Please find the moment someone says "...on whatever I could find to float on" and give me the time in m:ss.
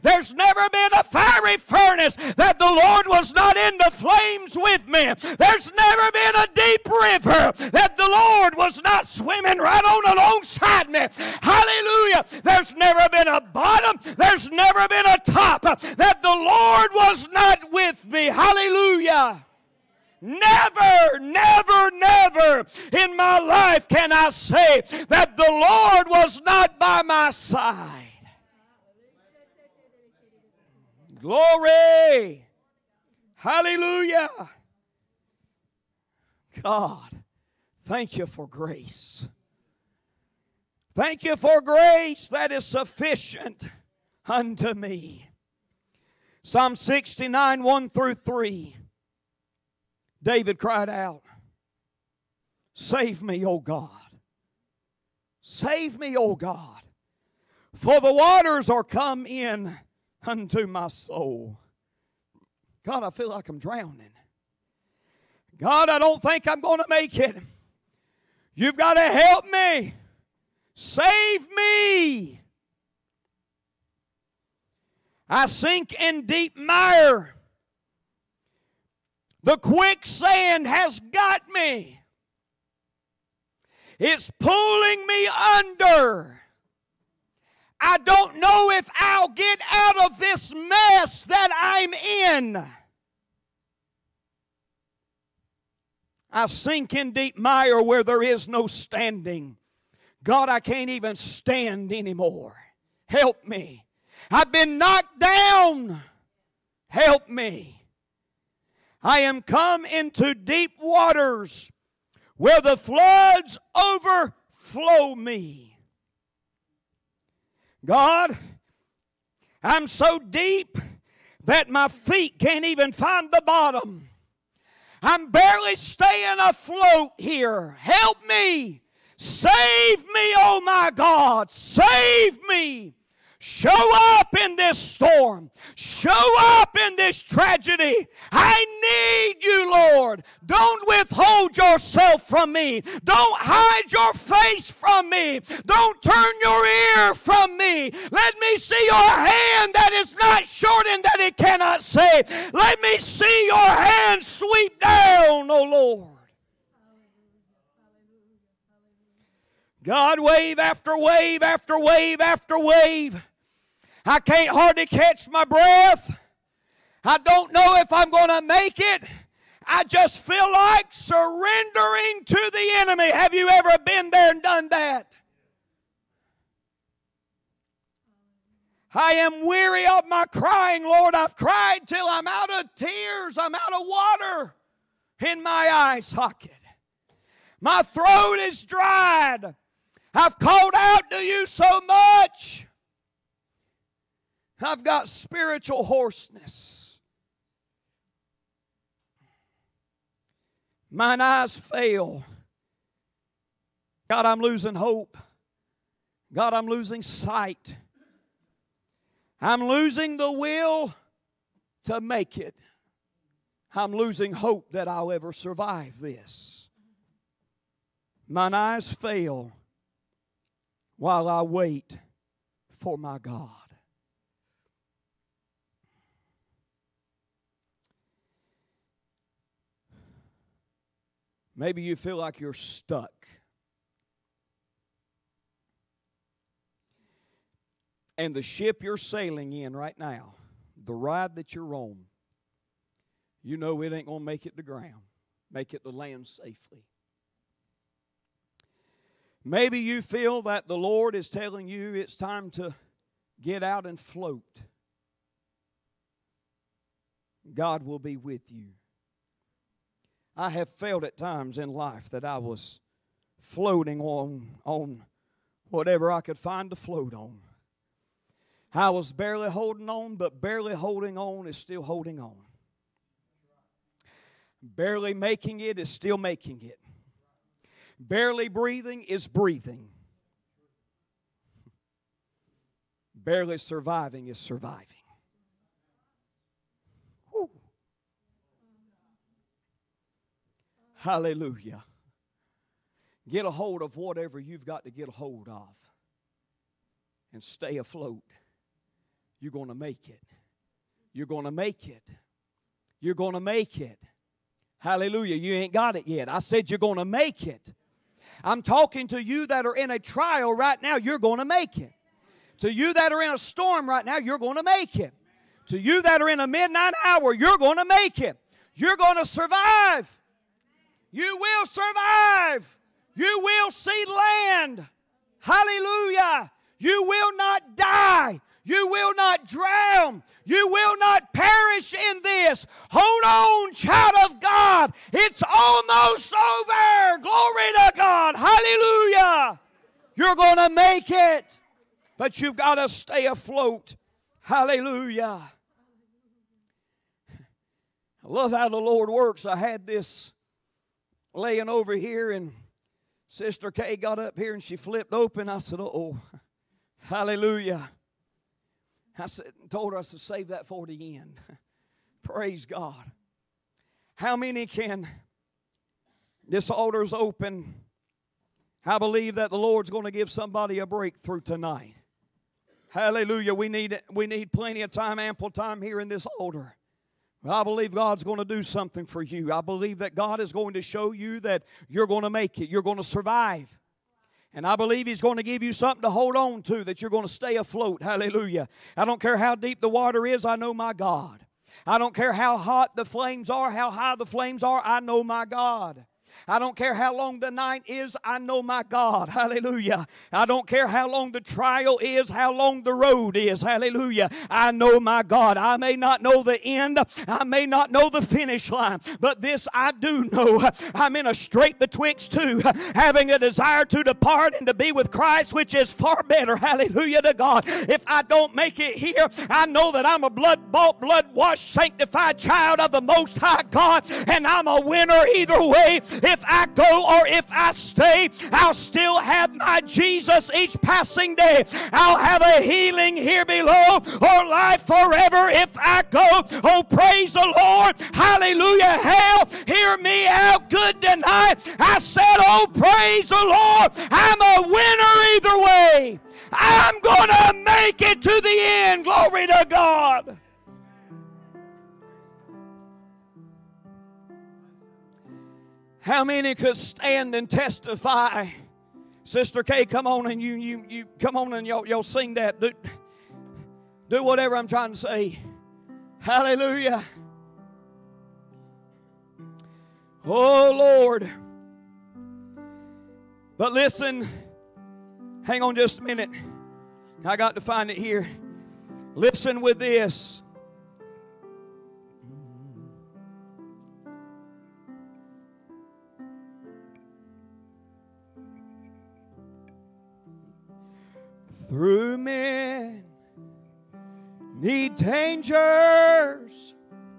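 4:24.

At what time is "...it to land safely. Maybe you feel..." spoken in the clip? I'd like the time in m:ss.
4:05.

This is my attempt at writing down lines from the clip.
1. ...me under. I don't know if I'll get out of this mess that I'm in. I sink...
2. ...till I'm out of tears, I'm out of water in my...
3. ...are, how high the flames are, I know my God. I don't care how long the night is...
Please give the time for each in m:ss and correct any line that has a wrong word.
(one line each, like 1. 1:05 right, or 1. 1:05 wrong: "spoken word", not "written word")
1. 1:25 right
2. 3:01 right
3. 6:33 right.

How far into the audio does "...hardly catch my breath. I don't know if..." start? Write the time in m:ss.
2:44.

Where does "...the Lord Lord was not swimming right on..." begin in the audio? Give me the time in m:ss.
0:07.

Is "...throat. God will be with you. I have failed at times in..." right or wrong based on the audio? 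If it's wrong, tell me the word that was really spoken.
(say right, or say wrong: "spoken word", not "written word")
wrong: "float", not "throat".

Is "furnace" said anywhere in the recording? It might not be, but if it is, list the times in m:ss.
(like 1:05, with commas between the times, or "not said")
0:01.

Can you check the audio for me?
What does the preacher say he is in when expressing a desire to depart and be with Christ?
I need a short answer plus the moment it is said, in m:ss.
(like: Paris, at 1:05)
A straight betwixt two, at 6:51.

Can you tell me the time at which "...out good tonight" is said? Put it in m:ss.
7:20.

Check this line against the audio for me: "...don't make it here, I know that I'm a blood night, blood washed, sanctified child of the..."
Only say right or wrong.
wrong.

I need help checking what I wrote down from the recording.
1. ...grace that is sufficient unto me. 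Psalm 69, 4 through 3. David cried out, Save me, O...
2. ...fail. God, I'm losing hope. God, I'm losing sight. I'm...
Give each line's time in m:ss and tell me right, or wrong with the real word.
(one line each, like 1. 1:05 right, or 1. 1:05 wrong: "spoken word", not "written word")
1. 0:41 wrong: "1", not "4"
2. 3:21 right.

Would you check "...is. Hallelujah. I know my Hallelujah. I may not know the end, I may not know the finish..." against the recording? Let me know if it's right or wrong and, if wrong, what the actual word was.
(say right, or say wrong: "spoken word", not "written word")
wrong: "God", not "Hallelujah".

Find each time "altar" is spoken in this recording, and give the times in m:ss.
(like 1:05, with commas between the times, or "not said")
6:06, 6:16.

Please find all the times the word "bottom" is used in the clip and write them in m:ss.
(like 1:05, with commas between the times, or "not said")
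0:13, 2:03.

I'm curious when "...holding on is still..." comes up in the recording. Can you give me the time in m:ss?
4:30.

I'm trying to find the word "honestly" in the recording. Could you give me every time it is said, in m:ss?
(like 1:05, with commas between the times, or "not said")
not said.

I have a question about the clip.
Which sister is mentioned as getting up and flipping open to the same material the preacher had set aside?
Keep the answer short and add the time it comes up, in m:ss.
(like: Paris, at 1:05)
Sister Kay, at 5:53.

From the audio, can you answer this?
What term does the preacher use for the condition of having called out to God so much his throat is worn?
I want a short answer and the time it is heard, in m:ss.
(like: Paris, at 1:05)
Spiritual hoarseness, at 3:15.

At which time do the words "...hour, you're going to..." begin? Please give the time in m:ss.
5:17.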